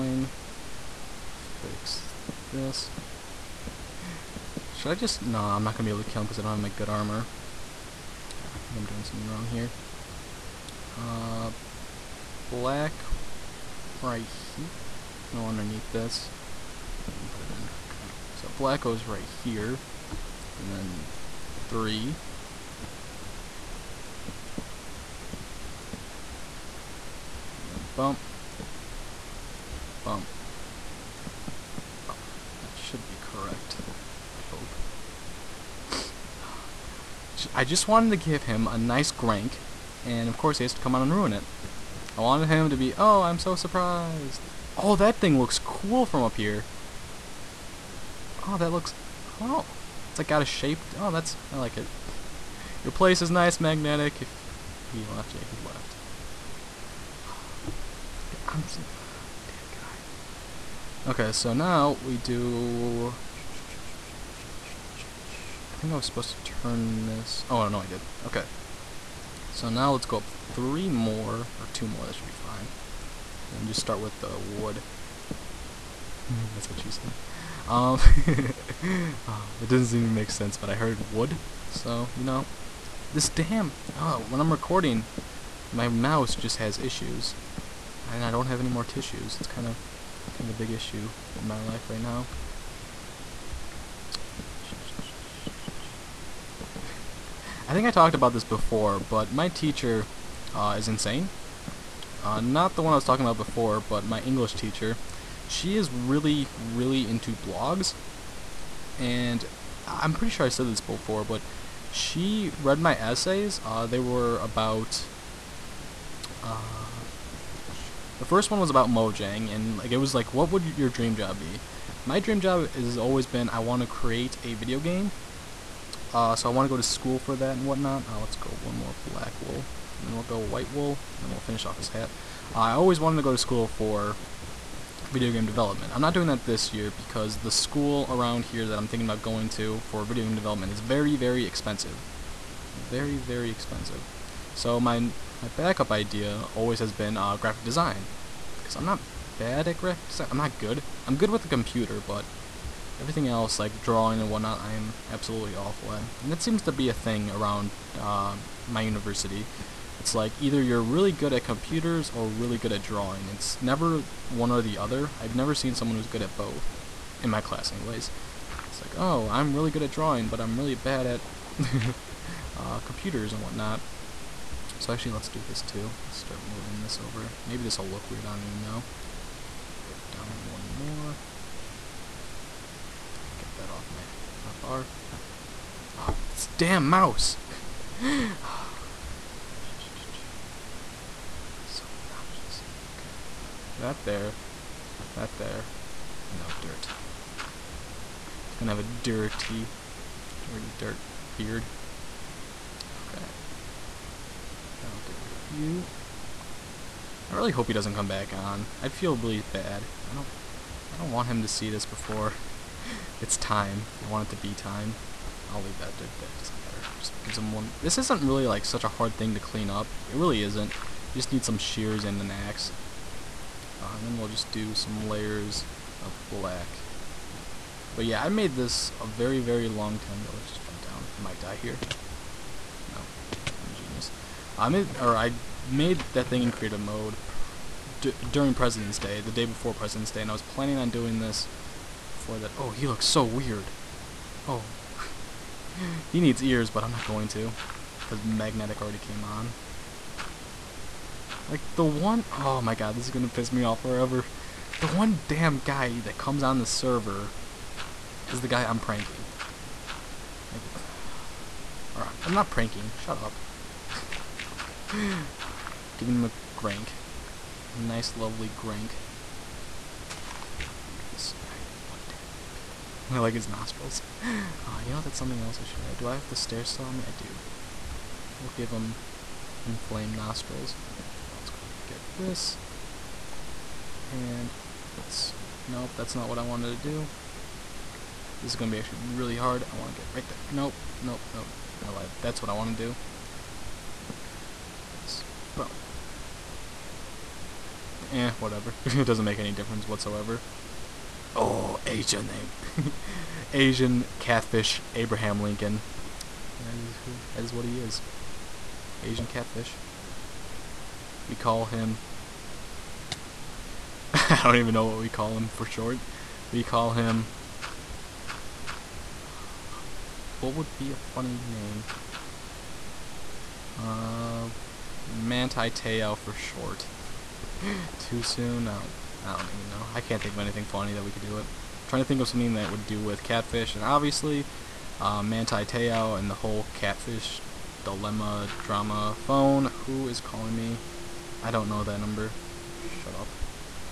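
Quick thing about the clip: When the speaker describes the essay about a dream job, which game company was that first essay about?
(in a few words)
Mojang.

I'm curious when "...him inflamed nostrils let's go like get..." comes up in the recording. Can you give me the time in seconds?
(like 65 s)
278 s.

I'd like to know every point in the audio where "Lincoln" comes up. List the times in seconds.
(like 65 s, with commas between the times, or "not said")
305 s.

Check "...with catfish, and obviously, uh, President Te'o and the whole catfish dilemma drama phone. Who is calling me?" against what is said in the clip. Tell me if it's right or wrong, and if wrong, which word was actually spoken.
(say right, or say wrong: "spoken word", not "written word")
wrong: "Manti", not "President".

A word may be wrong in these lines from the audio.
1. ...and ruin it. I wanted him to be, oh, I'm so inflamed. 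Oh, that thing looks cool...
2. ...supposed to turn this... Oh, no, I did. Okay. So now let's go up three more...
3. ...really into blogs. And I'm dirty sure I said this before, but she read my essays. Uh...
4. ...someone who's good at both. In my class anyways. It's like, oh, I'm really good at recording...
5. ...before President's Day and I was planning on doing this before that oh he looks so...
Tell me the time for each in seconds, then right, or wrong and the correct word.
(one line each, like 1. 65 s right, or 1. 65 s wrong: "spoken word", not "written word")
1. 41 s wrong: "surprised", not "inflamed"
2. 66 s right
3. 106 s wrong: "pretty", not "dirty"
4. 165 s wrong: "drawing", not "recording"
5. 239 s right.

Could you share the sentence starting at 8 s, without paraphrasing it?
I think I'm doing something wrong here.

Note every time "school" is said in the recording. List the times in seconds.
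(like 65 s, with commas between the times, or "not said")
126 s, 133 s, 137 s.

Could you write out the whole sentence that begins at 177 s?
Maybe this will look weird, I don't even know.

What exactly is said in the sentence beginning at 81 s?
So, you know, this damn, oh, when I'm recording, my mouse just has issues.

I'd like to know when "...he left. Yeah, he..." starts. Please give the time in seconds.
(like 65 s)
54 s.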